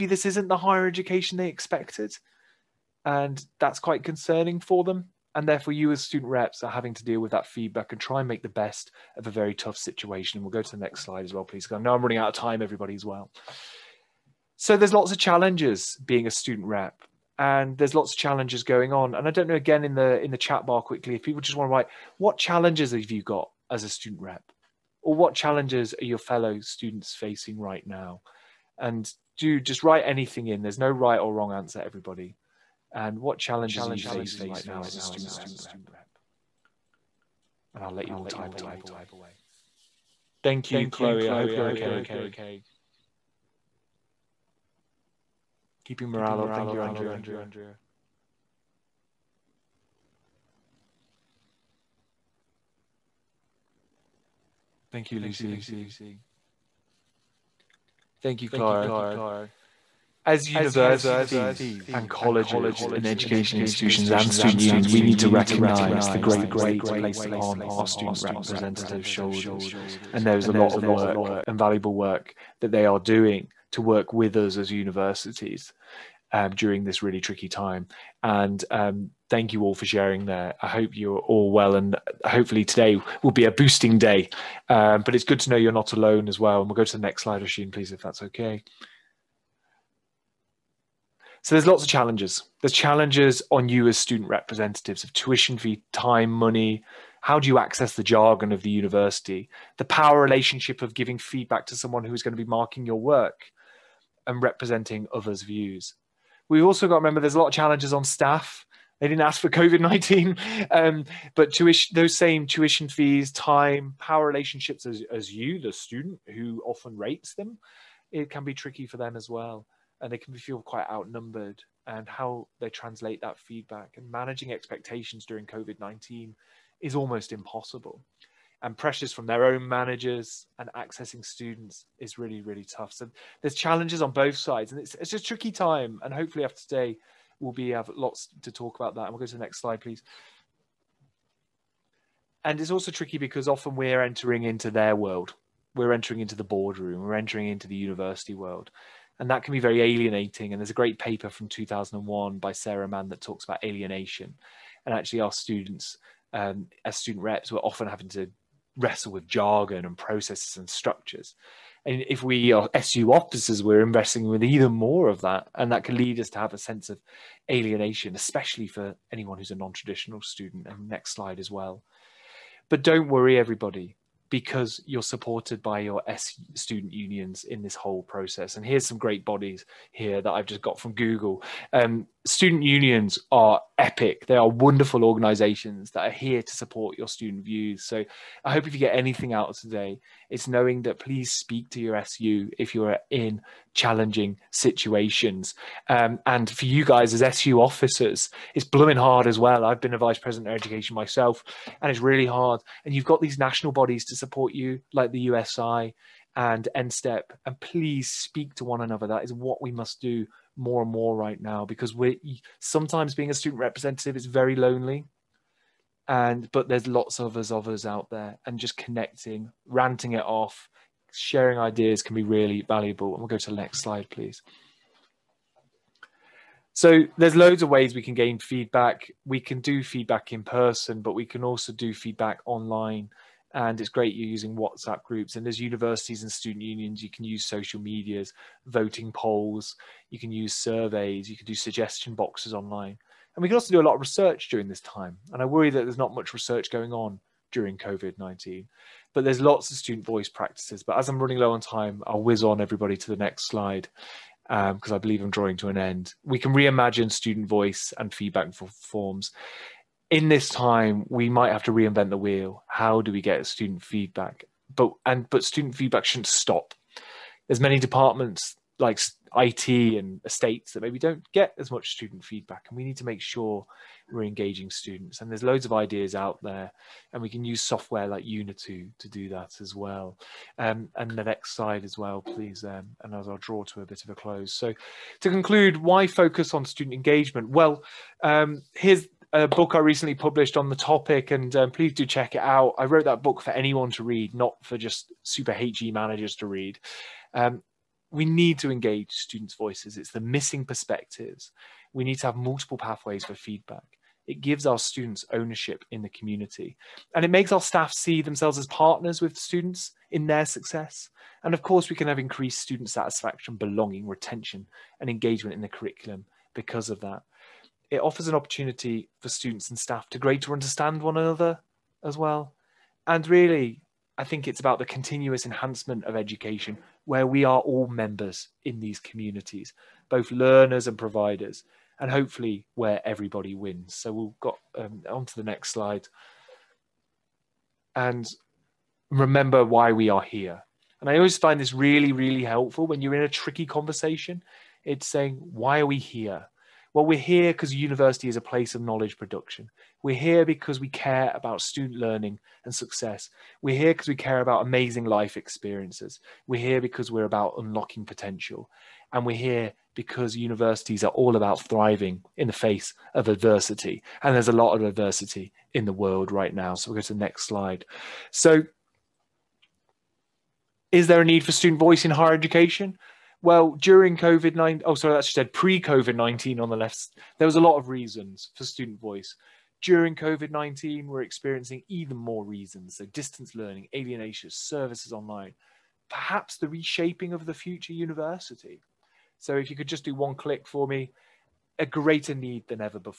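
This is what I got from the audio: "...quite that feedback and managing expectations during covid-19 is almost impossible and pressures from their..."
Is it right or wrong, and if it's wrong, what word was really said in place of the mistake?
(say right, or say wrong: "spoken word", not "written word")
wrong: "translate", not "quite".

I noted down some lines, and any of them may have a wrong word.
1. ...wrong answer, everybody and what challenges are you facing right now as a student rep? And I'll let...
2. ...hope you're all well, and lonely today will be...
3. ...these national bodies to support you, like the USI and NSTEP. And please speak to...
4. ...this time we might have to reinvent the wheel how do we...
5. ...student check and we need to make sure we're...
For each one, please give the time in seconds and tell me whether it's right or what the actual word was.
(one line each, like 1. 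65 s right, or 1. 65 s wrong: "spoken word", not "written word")
1. 31 s right
2. 80 s wrong: "hopefully", not "lonely"
3. 203 s right
4. 260 s right
5. 271 s wrong: "feedback", not "check".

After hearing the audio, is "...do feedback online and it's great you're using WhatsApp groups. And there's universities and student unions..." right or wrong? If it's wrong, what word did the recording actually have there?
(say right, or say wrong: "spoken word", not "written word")
right.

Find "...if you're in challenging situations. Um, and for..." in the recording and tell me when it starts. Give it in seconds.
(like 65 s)
192 s.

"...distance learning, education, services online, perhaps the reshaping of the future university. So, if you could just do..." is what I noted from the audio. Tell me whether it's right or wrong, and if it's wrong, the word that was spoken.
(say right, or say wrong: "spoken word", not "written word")
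wrong: "alienation", not "education".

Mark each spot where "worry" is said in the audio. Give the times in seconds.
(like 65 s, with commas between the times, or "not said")
173 s, 245 s.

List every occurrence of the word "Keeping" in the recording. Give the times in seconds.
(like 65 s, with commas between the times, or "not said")
45 s.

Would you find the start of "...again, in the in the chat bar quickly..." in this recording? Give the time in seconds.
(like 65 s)
19 s.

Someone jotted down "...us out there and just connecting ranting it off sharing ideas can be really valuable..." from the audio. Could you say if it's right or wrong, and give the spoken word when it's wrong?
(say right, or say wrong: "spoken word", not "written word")
right.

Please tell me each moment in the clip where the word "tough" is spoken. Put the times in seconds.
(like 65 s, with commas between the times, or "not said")
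9 s, 132 s.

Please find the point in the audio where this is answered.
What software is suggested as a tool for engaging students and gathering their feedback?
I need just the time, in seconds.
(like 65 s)
278 s.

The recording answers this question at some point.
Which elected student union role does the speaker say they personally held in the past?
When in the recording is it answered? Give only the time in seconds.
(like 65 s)
199 s.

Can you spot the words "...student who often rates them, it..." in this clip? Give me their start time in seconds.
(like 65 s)
115 s.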